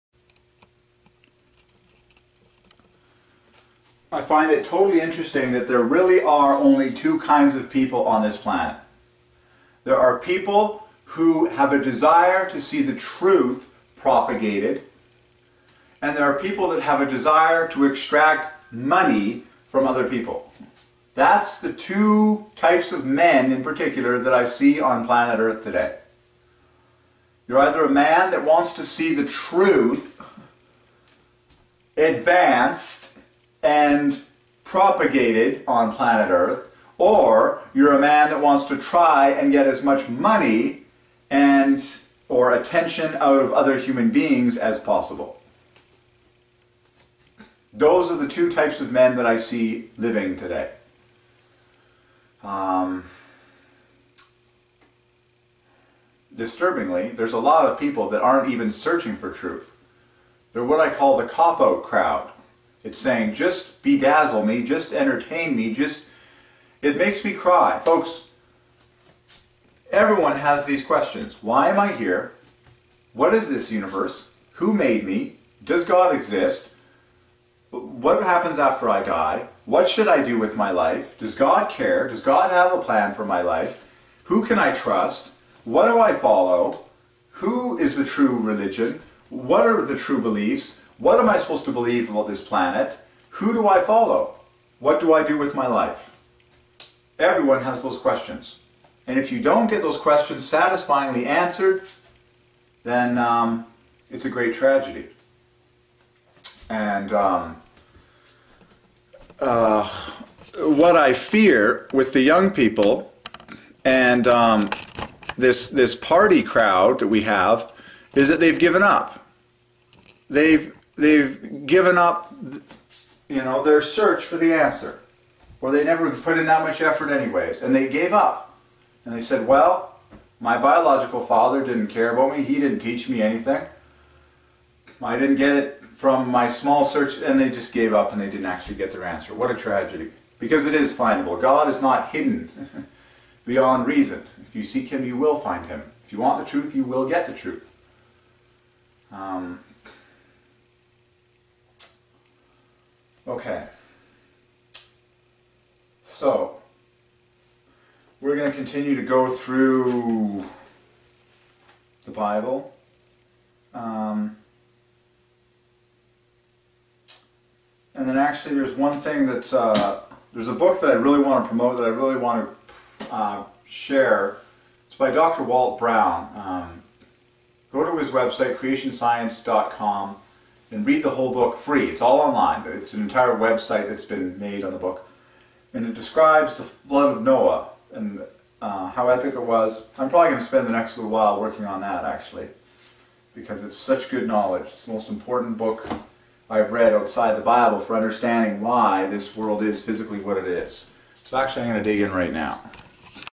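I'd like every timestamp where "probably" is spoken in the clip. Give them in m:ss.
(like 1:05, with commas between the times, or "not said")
3:10.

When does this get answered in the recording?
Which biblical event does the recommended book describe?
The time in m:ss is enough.
3:06.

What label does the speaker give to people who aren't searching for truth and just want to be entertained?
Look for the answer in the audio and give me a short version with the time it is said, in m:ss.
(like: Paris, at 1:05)
the cop out crowd, at 1:01.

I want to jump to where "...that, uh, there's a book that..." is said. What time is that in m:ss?
2:49.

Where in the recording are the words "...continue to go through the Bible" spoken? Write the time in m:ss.
2:38.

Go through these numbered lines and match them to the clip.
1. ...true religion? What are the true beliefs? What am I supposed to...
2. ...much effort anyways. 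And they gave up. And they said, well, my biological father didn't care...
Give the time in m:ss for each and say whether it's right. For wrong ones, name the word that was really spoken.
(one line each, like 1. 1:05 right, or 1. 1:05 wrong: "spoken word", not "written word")
1. 1:28 right
2. 2:06 right.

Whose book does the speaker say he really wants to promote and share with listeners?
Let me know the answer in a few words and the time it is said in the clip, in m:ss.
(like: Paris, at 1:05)
Dr. Walt Brown, at 2:55.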